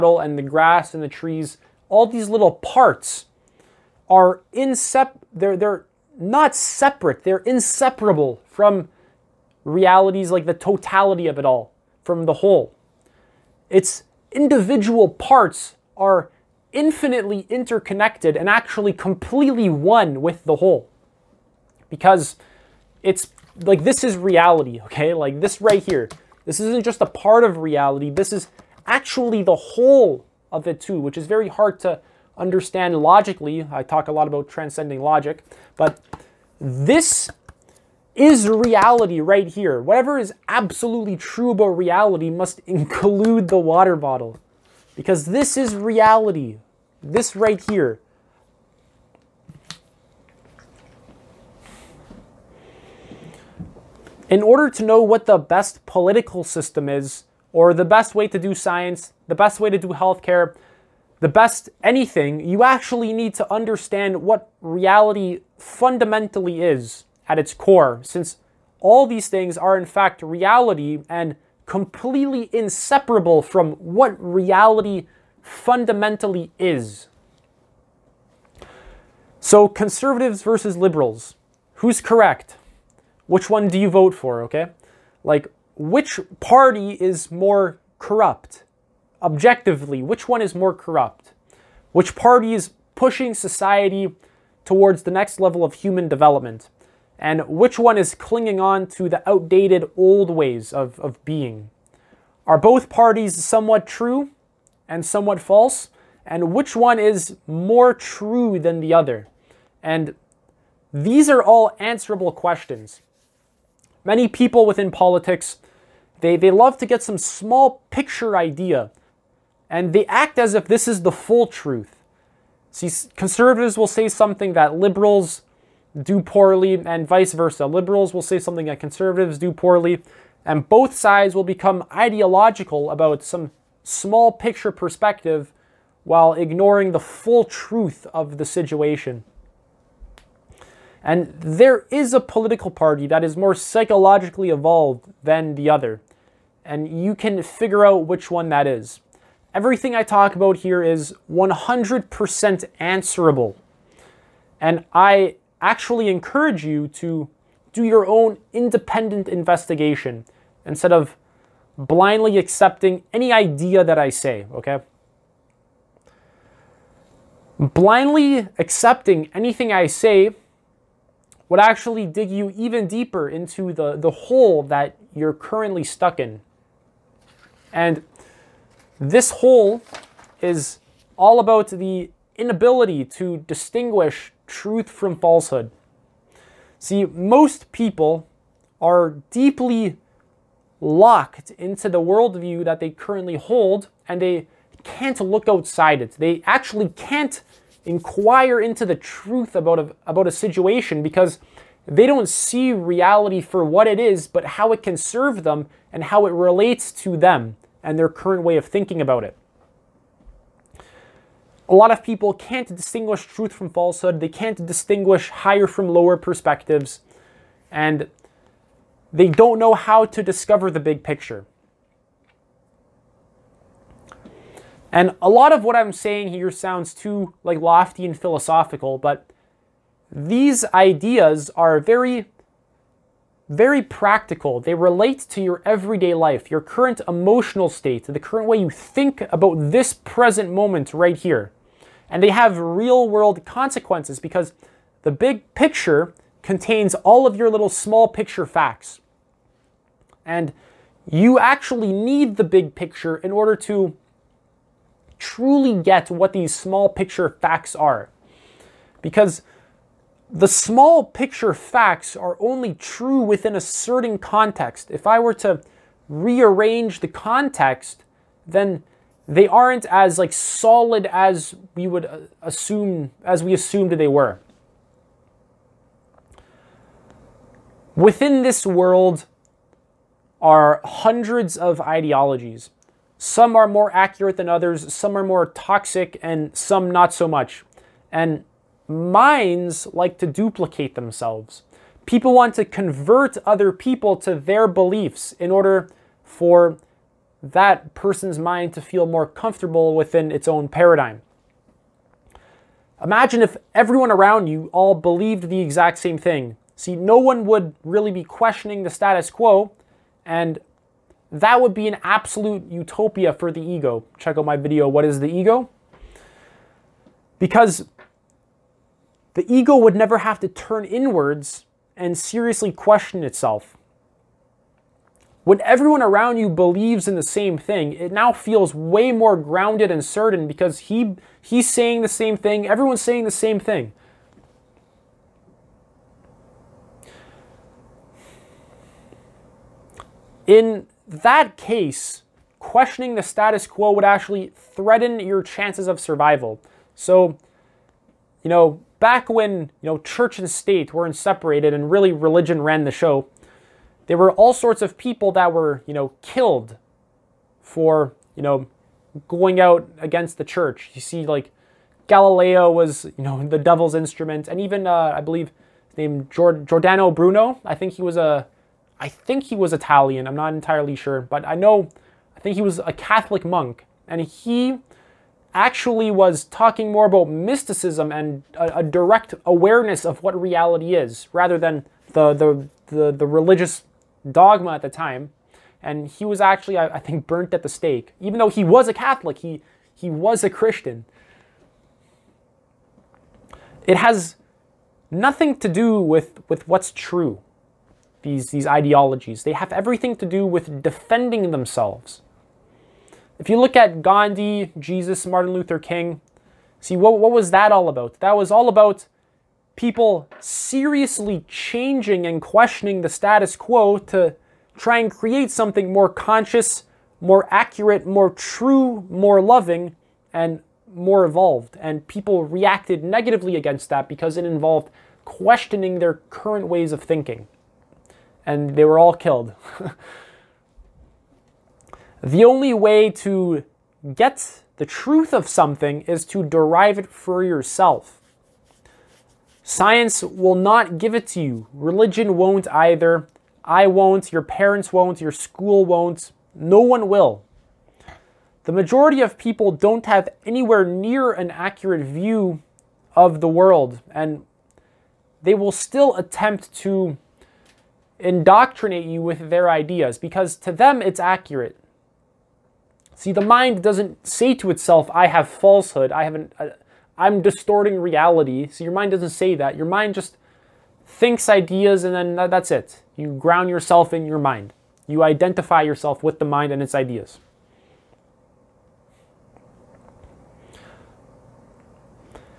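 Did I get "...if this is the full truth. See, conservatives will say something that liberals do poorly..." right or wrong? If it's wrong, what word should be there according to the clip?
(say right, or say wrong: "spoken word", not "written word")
right.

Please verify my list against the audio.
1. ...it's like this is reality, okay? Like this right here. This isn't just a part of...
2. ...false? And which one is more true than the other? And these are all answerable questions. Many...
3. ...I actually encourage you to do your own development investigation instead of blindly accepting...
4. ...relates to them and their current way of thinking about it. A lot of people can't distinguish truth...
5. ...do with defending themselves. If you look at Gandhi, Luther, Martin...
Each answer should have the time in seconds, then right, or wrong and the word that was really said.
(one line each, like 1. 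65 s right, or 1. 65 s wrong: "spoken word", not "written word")
1. 23 s right
2. 105 s right
3. 154 s wrong: "independent", not "development"
4. 206 s right
5. 400 s wrong: "Jesus", not "Luther".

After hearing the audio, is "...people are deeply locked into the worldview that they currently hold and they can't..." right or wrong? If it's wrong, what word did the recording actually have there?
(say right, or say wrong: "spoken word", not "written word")
right.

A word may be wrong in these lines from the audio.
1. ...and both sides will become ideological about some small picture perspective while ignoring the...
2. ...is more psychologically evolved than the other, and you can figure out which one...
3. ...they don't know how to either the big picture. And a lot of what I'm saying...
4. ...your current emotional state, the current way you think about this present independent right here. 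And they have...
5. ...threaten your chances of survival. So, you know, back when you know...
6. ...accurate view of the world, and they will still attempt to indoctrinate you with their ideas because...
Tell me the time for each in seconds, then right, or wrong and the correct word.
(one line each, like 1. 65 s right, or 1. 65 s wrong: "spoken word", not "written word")
1. 130 s right
2. 143 s right
3. 219 s wrong: "discover", not "either"
4. 236 s wrong: "moment", not "independent"
5. 344 s right
6. 451 s right.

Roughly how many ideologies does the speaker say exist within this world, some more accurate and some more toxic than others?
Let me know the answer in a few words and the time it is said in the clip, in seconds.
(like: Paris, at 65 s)
hundreds, at 280 s.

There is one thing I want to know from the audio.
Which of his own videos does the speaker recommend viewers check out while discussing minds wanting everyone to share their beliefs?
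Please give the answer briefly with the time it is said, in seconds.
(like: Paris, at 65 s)
What is the Ego?, at 314 s.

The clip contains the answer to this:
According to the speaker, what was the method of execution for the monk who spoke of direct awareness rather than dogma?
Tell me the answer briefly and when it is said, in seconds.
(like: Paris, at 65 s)
burnt at the stake, at 387 s.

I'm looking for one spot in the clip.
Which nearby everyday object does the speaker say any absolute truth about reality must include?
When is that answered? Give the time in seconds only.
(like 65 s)
43 s.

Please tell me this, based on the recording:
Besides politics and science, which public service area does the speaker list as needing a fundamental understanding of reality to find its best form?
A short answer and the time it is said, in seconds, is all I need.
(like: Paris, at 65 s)
healthcare, at 59 s.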